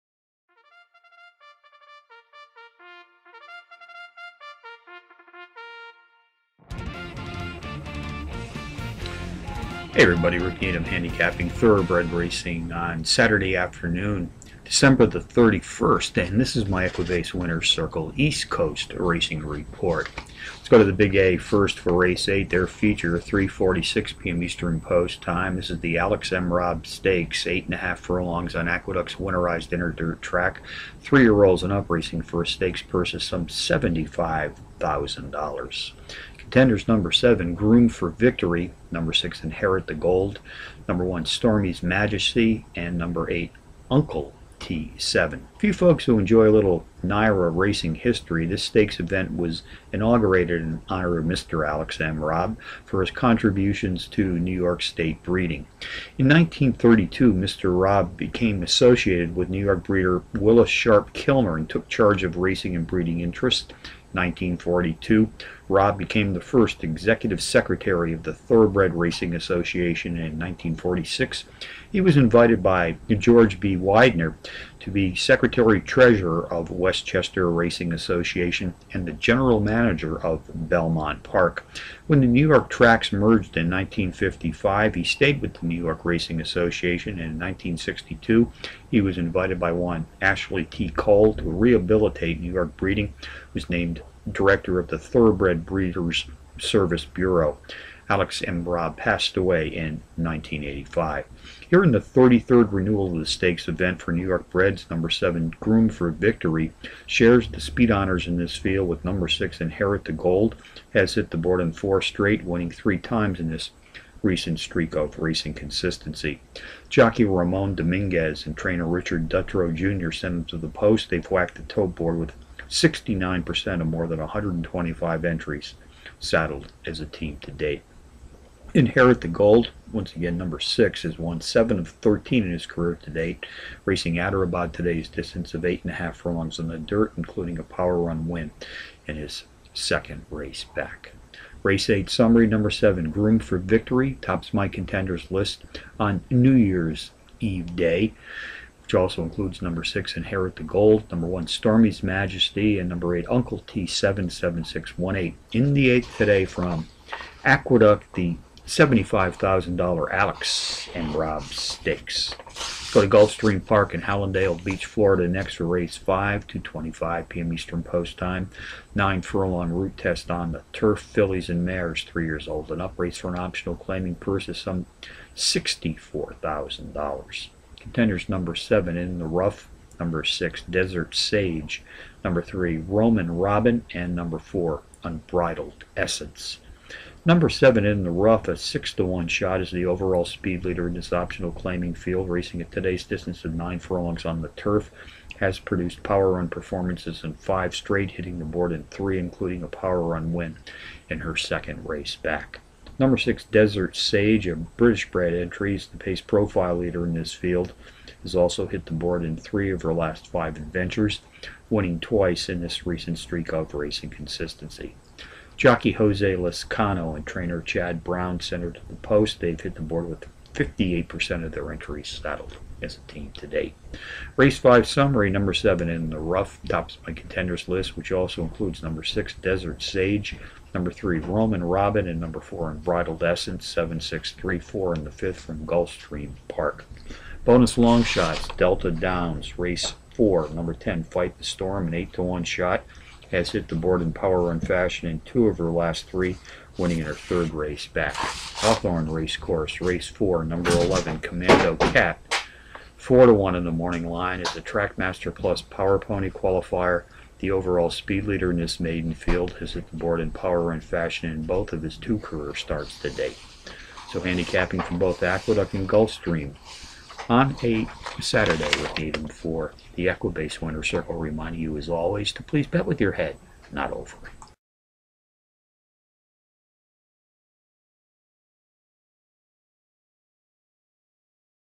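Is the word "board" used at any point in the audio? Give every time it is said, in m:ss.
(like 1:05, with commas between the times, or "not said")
1:51, 2:01, 3:18, 3:28, 3:39, 4:03, 4:19.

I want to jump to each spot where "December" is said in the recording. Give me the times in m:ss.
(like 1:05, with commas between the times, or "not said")
0:14.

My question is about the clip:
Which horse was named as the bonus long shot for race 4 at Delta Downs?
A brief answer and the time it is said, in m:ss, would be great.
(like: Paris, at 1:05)
Fight the Storm, at 4:01.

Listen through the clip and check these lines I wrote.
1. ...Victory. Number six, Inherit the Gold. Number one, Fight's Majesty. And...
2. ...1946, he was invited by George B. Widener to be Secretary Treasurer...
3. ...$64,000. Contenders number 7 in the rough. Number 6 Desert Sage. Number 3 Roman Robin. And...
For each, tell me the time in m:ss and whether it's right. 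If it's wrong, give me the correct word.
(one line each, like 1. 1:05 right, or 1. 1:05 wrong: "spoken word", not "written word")
1. 0:38 wrong: "Stormy", not "Fight"
2. 1:10 right
3. 2:55 right.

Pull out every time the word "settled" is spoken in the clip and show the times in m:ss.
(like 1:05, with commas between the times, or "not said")
3:42.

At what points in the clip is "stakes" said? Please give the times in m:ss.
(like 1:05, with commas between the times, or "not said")
0:26, 0:32, 0:48, 1:43, 2:41.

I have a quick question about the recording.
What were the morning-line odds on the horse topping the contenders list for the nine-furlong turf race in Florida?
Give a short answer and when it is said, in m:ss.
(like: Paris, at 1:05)
6 to 1, at 3:08.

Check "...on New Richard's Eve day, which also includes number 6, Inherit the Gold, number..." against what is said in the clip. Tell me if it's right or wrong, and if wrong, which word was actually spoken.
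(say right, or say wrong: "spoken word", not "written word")
wrong: "Year", not "Richard".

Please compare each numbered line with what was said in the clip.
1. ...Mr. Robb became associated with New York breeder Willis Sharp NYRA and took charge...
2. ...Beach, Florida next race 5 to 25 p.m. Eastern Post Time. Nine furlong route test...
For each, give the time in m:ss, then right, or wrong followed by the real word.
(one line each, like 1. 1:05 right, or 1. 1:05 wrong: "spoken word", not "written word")
1. 0:57 wrong: "Kilmer", not "NYRA"
2. 2:44 right.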